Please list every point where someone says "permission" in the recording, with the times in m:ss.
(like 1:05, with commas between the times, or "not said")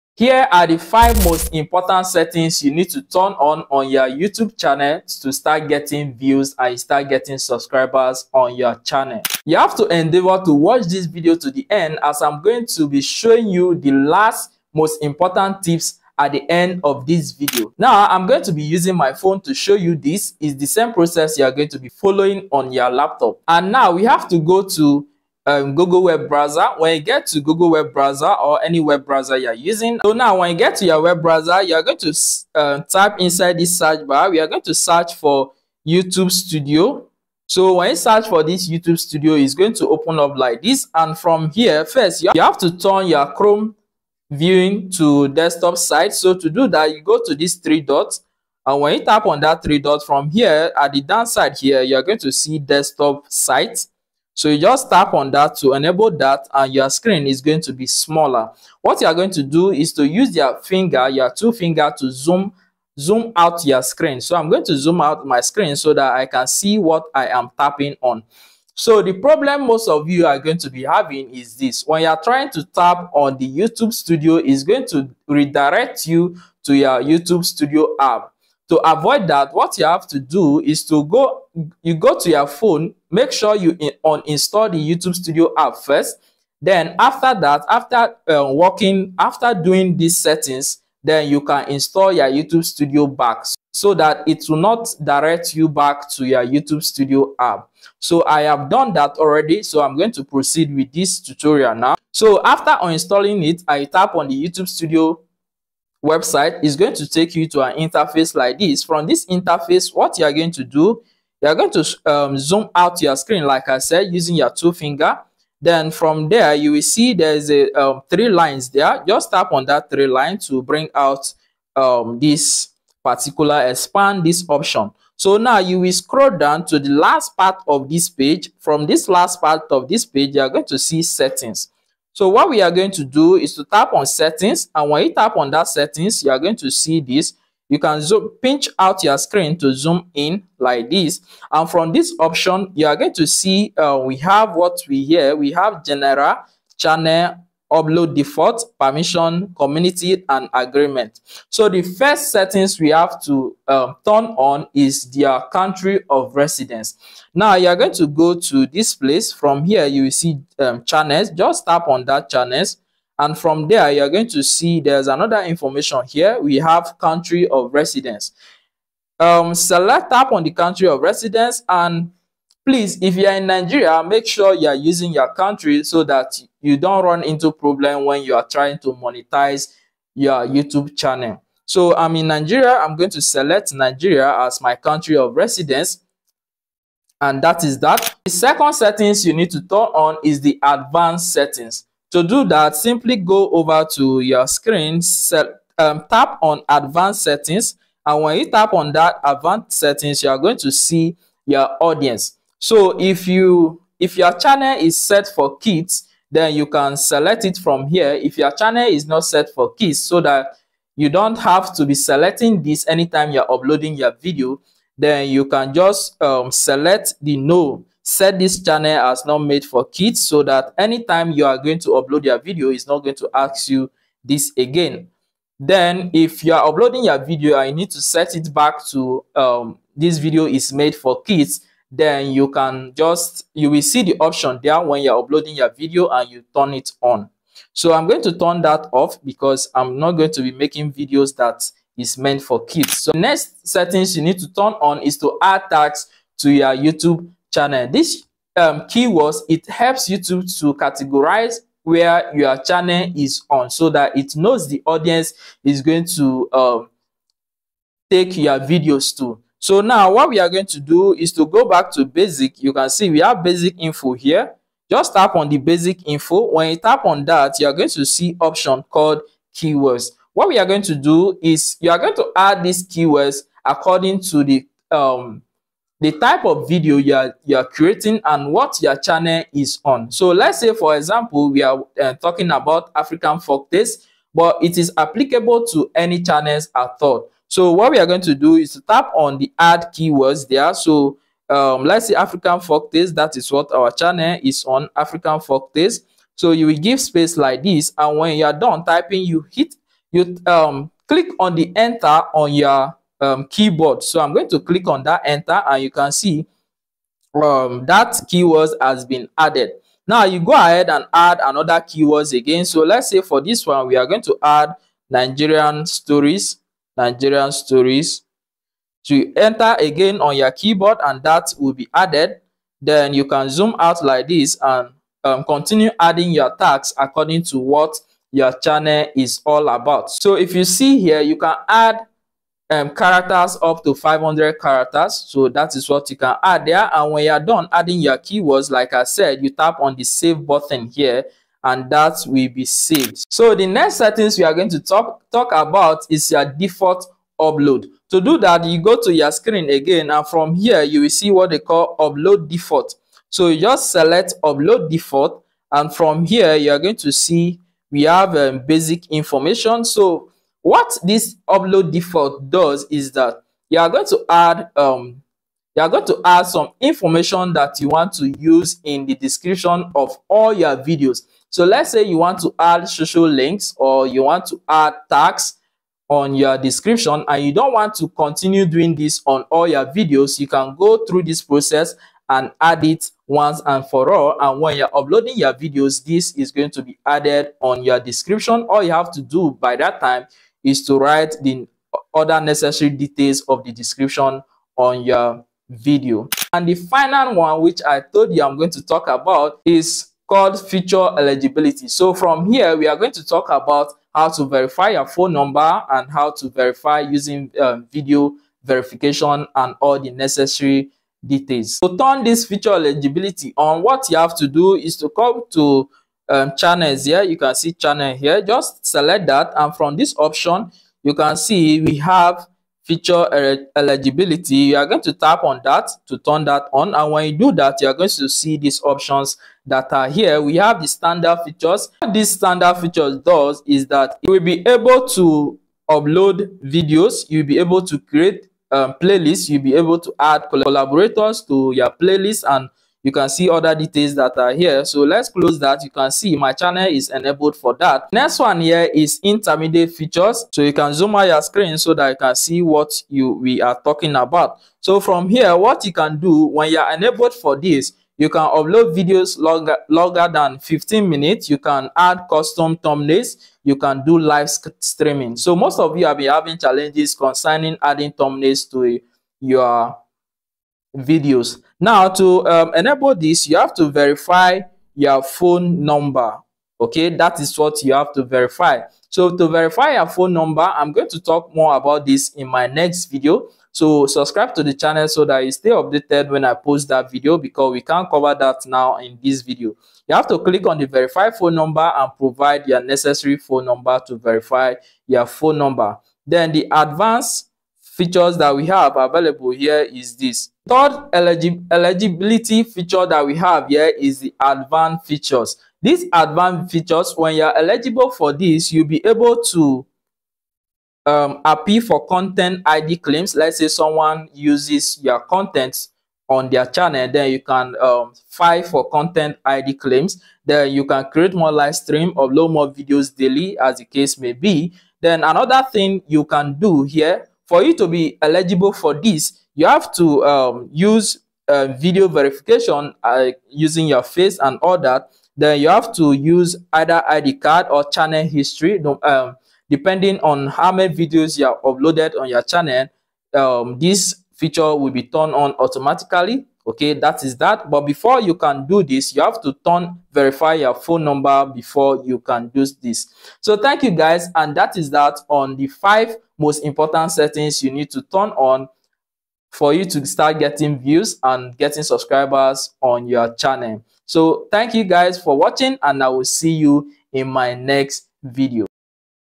2:28.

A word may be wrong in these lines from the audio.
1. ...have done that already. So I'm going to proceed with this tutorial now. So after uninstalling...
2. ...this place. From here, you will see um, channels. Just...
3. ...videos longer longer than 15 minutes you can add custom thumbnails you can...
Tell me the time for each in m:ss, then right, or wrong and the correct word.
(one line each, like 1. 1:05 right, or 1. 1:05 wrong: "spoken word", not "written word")
1. 1:38 right
2. 2:38 right
3. 7:38 right.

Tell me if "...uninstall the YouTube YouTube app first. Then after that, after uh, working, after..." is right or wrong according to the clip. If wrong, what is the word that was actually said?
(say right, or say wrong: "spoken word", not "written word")
wrong: "Studio", not "YouTube".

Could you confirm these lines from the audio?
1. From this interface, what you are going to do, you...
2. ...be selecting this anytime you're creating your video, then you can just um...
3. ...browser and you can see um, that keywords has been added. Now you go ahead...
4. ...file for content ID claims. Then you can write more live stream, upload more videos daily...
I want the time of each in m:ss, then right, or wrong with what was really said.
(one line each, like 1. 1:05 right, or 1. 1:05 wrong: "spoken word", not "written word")
1. 1:48 right
2. 3:31 wrong: "uploading", not "creating"
3. 5:05 wrong: "enter", not "browser"
4. 8:38 wrong: "create", not "write".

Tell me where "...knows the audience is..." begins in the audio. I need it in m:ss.
4:14.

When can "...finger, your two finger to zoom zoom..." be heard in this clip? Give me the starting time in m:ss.
1:00.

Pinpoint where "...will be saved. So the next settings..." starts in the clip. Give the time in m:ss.
5:42.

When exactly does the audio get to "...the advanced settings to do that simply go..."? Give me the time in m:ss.
3:10.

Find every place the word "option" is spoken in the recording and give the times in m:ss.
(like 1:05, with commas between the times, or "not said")
2:04, 2:22, 3:54, 4:28, 7:00, 7:08.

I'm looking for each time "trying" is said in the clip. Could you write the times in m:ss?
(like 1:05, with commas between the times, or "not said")
1:12, 2:58.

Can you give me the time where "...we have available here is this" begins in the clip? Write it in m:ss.
8:18.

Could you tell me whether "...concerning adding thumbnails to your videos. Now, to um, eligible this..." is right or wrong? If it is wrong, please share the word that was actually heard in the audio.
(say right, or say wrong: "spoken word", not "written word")
wrong: "enable", not "eligible".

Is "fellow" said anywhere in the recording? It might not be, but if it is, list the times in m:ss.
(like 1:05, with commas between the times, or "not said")
not said.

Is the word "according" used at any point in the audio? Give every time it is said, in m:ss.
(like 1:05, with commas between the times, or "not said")
4:33, 5:26.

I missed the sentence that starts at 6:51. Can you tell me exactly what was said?
To turn this feature eligibility on, what you have to do is to come to um, channels here.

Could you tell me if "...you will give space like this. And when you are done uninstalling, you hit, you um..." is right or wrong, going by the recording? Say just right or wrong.
wrong.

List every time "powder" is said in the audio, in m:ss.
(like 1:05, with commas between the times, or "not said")
not said.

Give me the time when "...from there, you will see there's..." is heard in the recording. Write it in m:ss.
1:55.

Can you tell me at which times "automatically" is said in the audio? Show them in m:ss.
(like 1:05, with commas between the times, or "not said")
9:05.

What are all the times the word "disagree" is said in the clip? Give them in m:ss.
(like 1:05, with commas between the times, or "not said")
not said.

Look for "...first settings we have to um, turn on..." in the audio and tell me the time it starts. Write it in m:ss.
2:31.